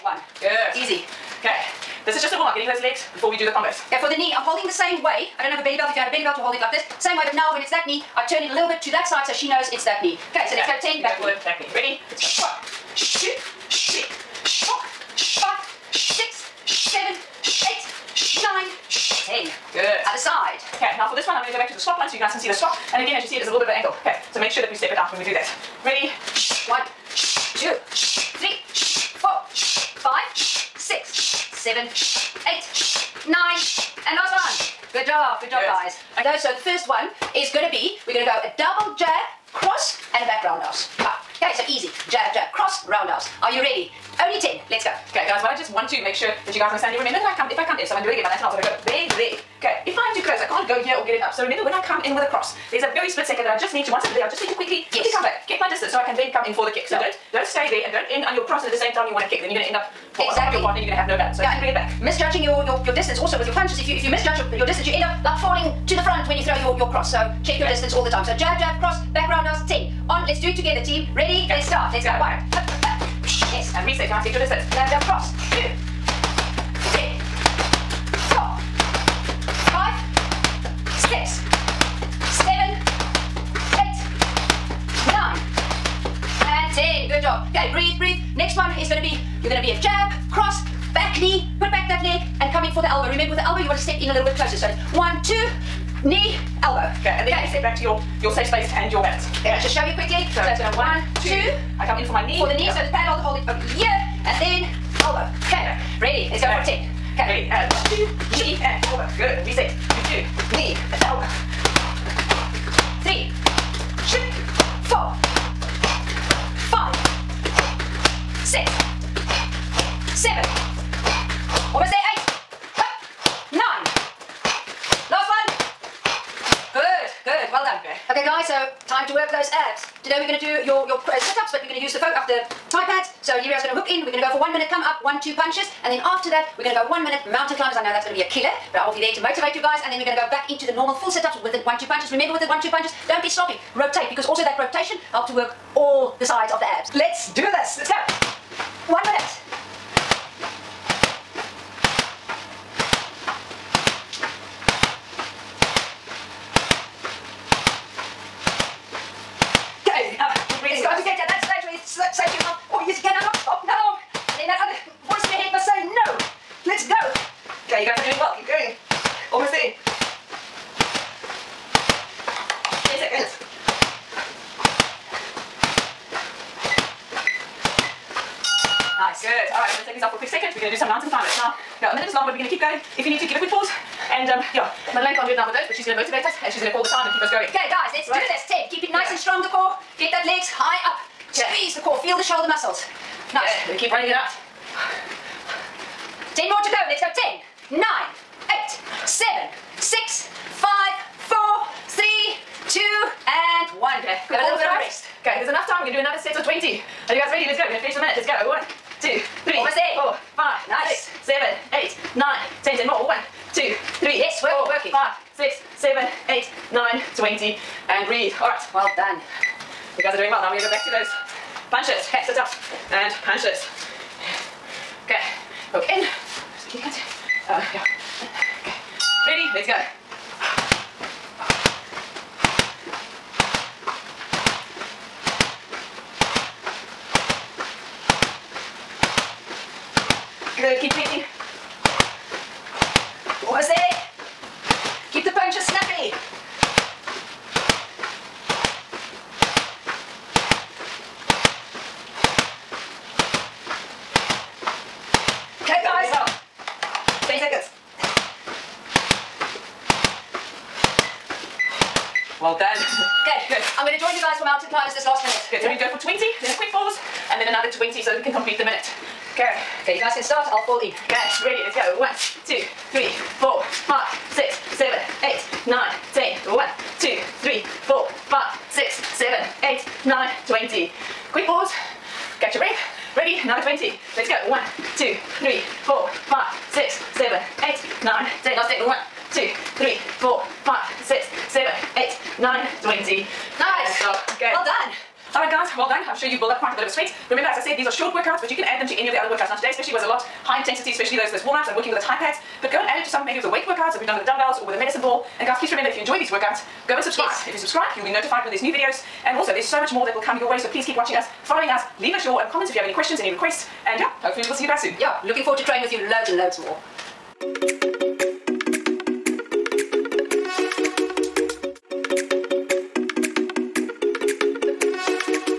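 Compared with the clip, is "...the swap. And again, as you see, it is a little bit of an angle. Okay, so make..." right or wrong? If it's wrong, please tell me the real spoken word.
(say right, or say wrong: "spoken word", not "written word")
right.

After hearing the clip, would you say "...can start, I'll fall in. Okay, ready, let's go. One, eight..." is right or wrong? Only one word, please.
wrong.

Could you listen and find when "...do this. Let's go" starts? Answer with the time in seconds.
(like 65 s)
147 s.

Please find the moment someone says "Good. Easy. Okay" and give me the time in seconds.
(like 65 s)
0 s.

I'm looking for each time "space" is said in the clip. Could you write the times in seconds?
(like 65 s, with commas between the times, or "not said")
98 s.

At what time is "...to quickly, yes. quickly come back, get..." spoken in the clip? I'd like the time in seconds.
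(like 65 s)
54 s.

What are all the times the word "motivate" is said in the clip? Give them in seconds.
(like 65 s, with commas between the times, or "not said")
139 s, 185 s.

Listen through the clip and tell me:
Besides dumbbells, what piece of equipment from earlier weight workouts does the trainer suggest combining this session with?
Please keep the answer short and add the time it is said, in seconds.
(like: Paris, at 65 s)
medicine ball, at 304 s.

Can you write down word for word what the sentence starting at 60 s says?
on top of your partner and you're going to have no balance.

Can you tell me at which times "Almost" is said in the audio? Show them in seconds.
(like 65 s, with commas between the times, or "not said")
169 s, 209 s.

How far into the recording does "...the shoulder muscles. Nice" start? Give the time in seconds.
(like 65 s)
192 s.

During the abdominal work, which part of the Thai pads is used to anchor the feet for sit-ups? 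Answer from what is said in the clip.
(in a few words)
the foot.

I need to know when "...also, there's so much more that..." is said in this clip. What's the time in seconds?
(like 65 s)
309 s.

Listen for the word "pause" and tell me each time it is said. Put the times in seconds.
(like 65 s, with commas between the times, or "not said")
183 s, 266 s, 281 s.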